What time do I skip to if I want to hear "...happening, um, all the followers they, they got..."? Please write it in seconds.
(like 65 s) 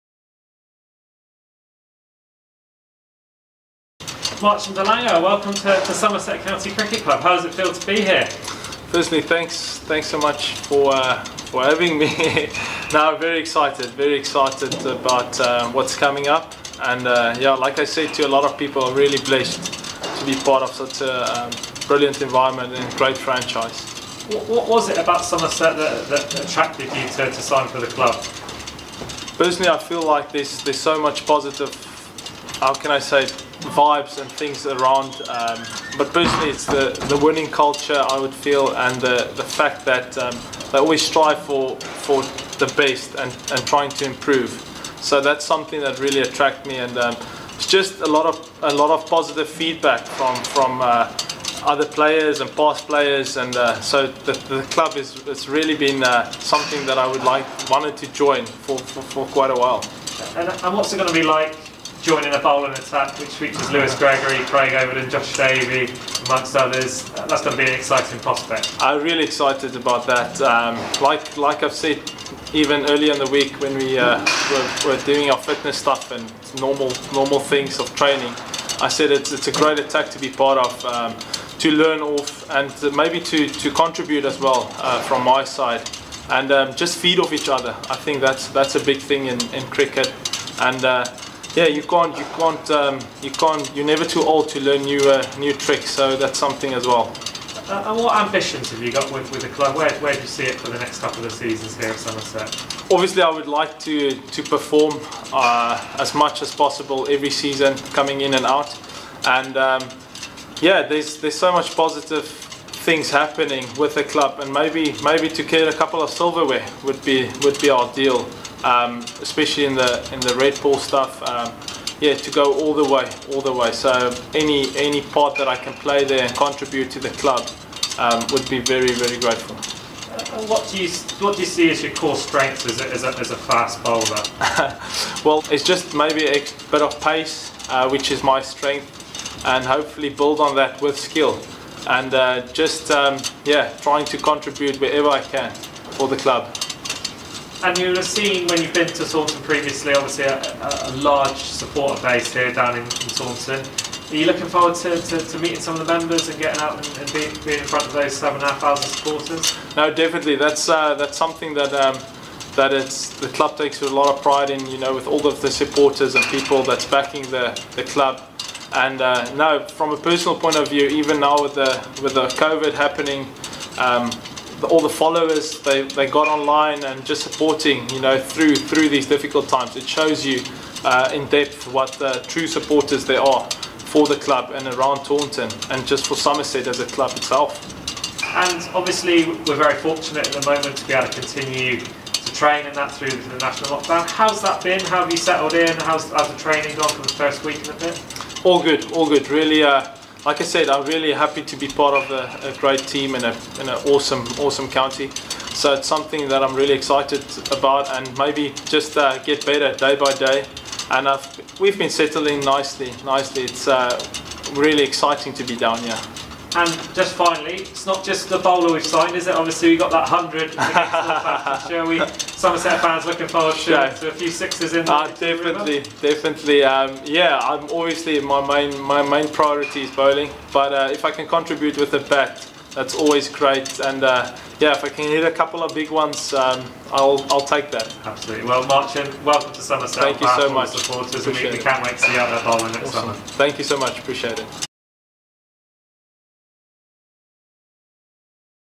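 172 s.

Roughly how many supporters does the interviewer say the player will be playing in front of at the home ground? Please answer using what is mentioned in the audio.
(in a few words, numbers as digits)
7,500.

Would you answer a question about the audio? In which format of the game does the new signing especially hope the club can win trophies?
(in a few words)
Red ball.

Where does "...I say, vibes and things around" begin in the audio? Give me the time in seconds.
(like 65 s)
32 s.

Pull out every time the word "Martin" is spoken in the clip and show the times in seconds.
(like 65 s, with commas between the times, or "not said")
238 s.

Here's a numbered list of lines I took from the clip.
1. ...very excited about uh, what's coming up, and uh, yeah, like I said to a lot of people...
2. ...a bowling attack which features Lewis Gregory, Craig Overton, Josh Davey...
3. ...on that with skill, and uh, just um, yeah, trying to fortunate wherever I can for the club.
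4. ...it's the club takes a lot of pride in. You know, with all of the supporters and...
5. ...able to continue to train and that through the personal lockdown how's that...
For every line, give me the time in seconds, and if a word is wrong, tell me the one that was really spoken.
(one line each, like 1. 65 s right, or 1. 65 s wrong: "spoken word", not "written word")
1. 13 s right
2. 62 s right
3. 140 s wrong: "contribute", not "fortunate"
4. 162 s right
5. 190 s wrong: "national", not "personal".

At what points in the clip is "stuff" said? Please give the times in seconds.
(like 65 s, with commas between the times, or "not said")
75 s, 120 s.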